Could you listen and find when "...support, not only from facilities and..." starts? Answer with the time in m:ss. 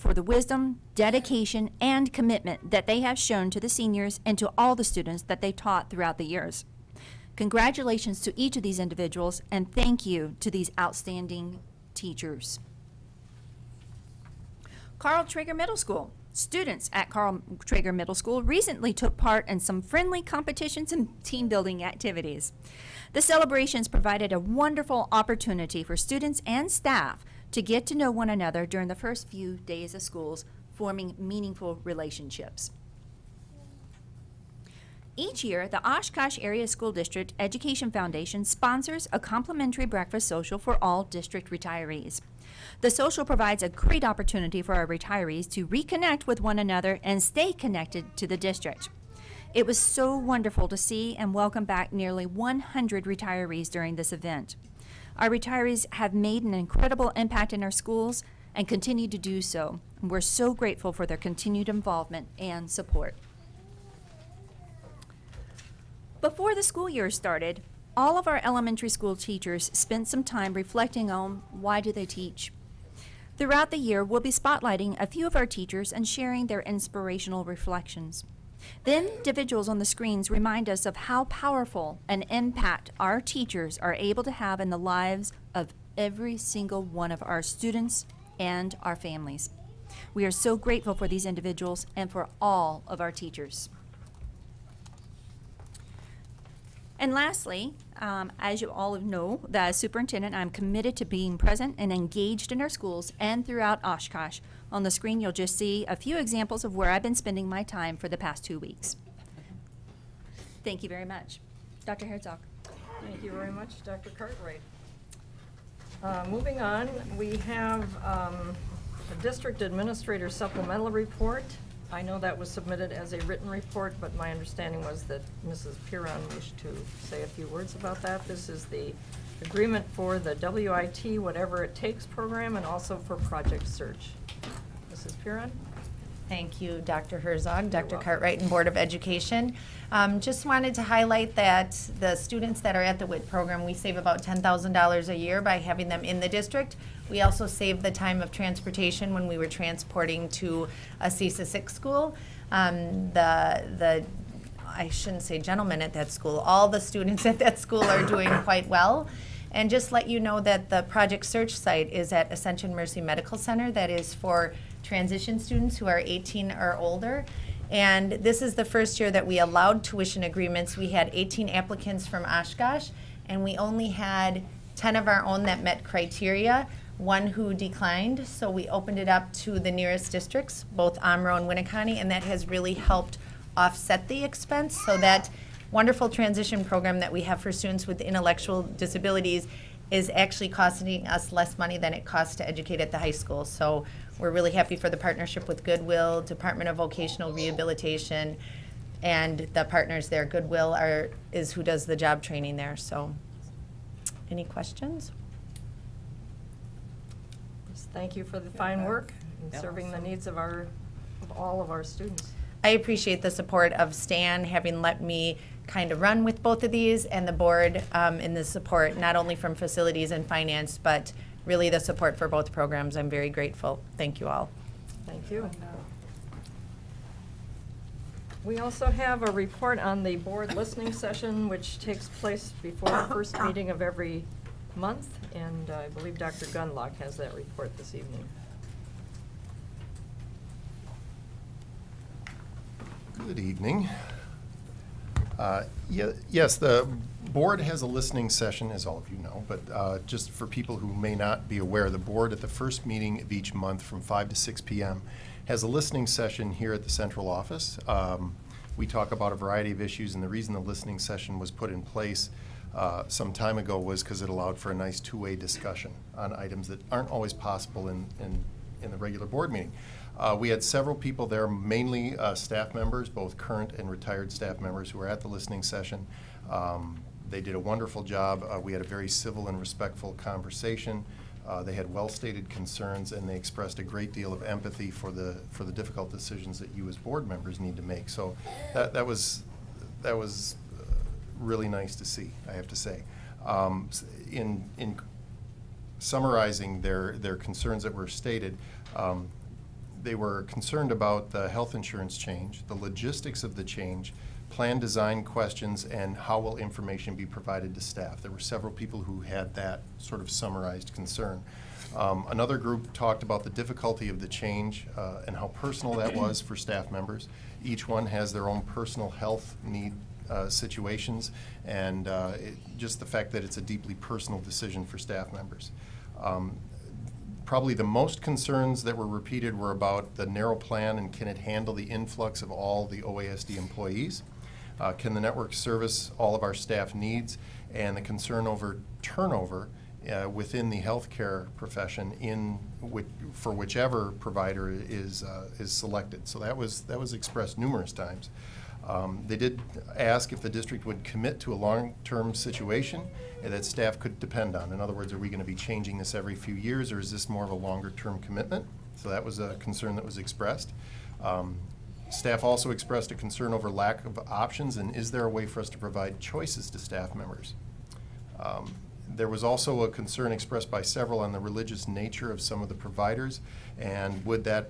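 3:38.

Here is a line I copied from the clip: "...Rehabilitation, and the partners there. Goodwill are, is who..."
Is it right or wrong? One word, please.
right.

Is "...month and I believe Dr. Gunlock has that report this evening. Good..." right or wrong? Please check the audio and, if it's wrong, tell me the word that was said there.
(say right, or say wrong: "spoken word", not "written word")
right.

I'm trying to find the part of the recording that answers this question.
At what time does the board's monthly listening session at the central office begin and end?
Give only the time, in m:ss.
4:14.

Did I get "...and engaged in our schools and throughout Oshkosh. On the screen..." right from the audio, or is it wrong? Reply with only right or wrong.
right.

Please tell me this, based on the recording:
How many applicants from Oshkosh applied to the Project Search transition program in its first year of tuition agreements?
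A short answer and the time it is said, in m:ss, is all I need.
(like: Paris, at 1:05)
18, at 2:51.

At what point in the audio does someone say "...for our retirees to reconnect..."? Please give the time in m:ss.
0:44.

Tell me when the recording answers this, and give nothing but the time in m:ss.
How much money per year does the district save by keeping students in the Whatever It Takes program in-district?
2:24.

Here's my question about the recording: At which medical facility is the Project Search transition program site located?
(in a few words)
Ascension Mercy Medical Center.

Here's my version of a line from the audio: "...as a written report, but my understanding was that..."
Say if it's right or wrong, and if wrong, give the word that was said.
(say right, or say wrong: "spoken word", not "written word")
right.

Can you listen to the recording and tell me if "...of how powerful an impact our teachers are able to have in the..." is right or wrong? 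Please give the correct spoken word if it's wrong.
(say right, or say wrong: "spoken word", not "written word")
right.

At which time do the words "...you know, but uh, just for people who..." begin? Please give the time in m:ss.
4:09.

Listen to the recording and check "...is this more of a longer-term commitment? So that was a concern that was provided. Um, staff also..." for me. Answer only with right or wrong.
wrong.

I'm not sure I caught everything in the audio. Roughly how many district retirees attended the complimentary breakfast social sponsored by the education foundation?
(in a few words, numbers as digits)
nearly 100.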